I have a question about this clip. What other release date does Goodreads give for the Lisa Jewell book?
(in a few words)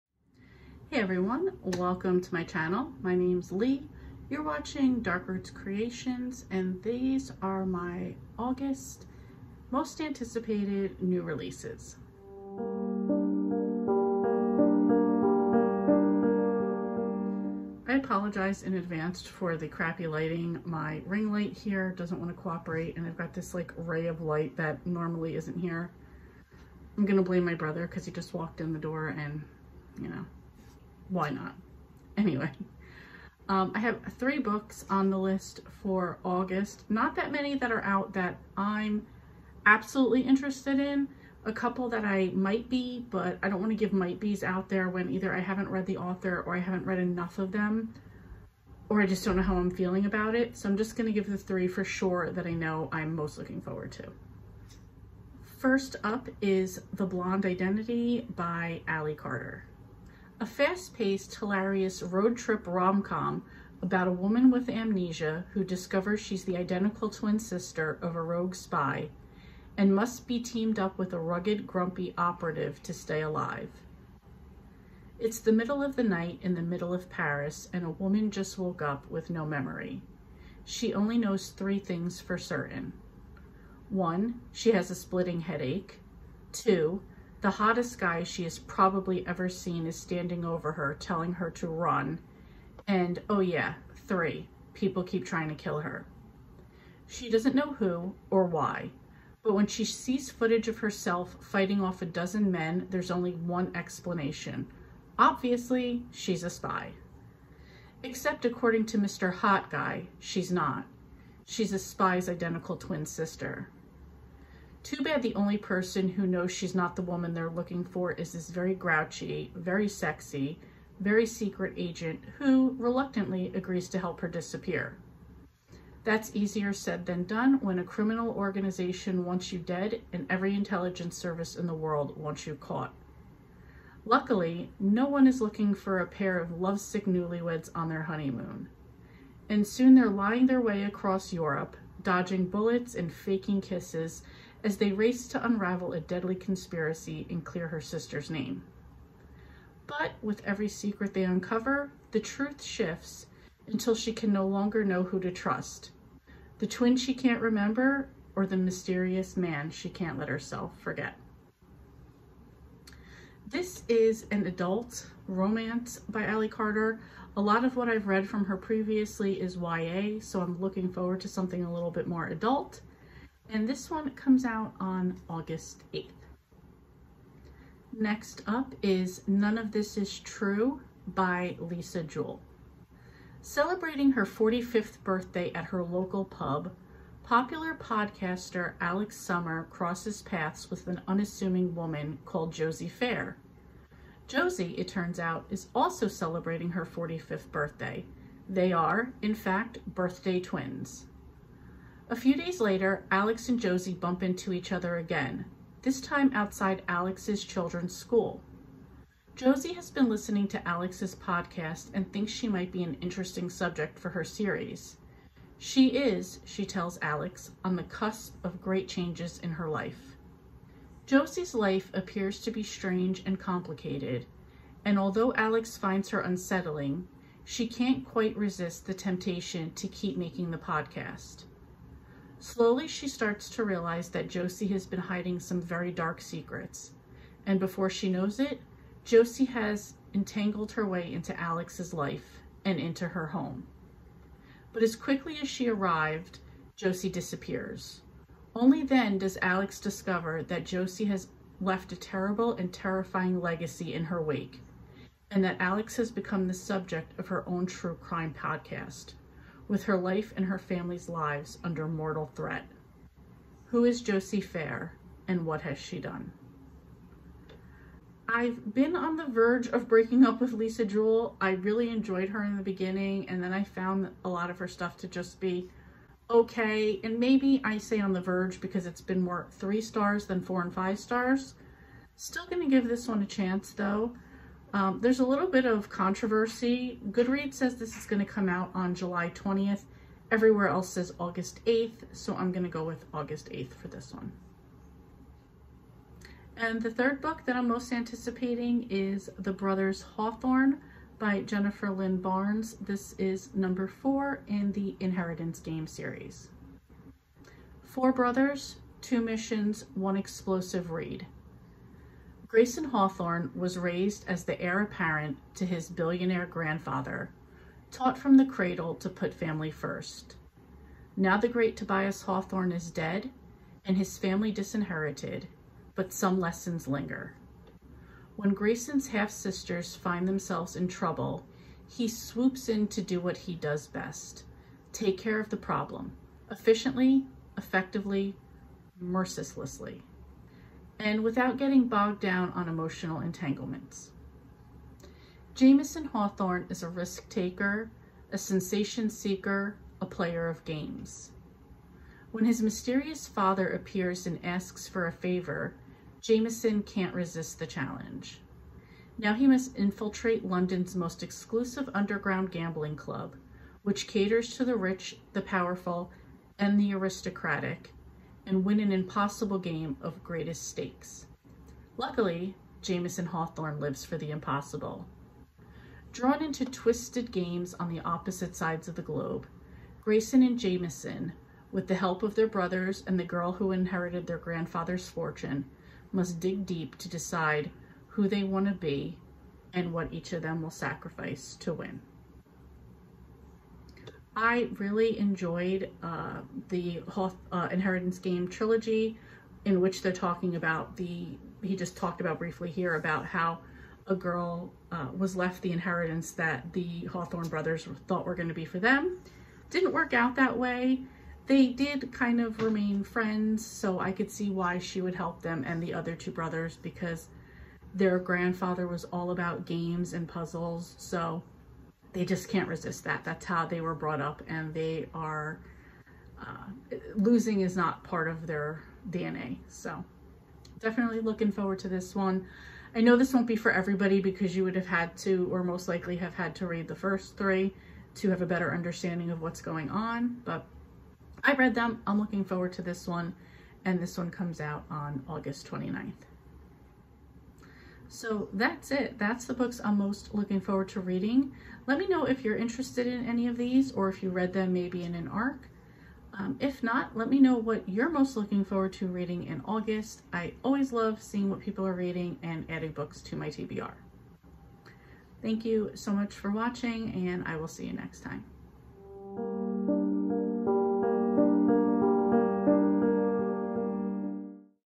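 July 20th.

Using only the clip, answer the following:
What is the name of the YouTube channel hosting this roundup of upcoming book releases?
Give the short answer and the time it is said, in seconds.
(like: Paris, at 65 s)
Dark Roots Creations, at 5 s.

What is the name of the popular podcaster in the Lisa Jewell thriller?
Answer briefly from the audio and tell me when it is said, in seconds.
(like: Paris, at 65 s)
Alex Summer, at 188 s.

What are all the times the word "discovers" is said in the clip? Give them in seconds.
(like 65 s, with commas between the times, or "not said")
65 s, 249 s.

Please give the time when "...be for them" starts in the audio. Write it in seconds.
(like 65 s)
408 s.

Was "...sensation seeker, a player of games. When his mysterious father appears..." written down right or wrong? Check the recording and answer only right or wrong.
right.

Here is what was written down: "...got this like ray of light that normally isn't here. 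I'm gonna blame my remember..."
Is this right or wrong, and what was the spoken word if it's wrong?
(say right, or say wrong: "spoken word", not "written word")
wrong: "brother", not "remember".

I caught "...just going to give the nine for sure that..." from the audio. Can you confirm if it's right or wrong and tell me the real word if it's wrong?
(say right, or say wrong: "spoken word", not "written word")
wrong: "three", not "nine".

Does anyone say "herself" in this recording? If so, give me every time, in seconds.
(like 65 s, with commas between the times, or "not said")
100 s, 160 s.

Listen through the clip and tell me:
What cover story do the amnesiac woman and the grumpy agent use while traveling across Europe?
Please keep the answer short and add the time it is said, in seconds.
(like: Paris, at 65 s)
newlyweds on their honeymoon, at 137 s.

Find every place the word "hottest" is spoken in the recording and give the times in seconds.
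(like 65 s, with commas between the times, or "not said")
87 s.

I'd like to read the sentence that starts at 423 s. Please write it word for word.
That's how they were brought up and they are, uh, losing is not part of their DNA.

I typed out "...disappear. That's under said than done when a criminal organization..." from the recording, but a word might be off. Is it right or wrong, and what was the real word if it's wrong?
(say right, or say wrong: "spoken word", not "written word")
wrong: "easier", not "under".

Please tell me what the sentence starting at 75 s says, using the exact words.
It's the middle of the night in the middle of Paris, and a woman just woke up with no memory.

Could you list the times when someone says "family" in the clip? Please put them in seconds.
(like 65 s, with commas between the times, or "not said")
260 s, 319 s, 324 s.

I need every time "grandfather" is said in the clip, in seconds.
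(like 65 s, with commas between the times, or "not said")
316 s, 384 s, 418 s.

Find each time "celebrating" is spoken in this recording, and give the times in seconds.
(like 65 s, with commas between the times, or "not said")
183 s, 196 s.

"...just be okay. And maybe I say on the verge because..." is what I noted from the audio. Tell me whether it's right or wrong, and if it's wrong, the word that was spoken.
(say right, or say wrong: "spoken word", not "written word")
right.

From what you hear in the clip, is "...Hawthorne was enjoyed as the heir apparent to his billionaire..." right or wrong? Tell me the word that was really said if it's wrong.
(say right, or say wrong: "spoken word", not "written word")
wrong: "raised", not "enjoyed".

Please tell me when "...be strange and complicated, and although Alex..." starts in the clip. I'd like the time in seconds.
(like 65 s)
222 s.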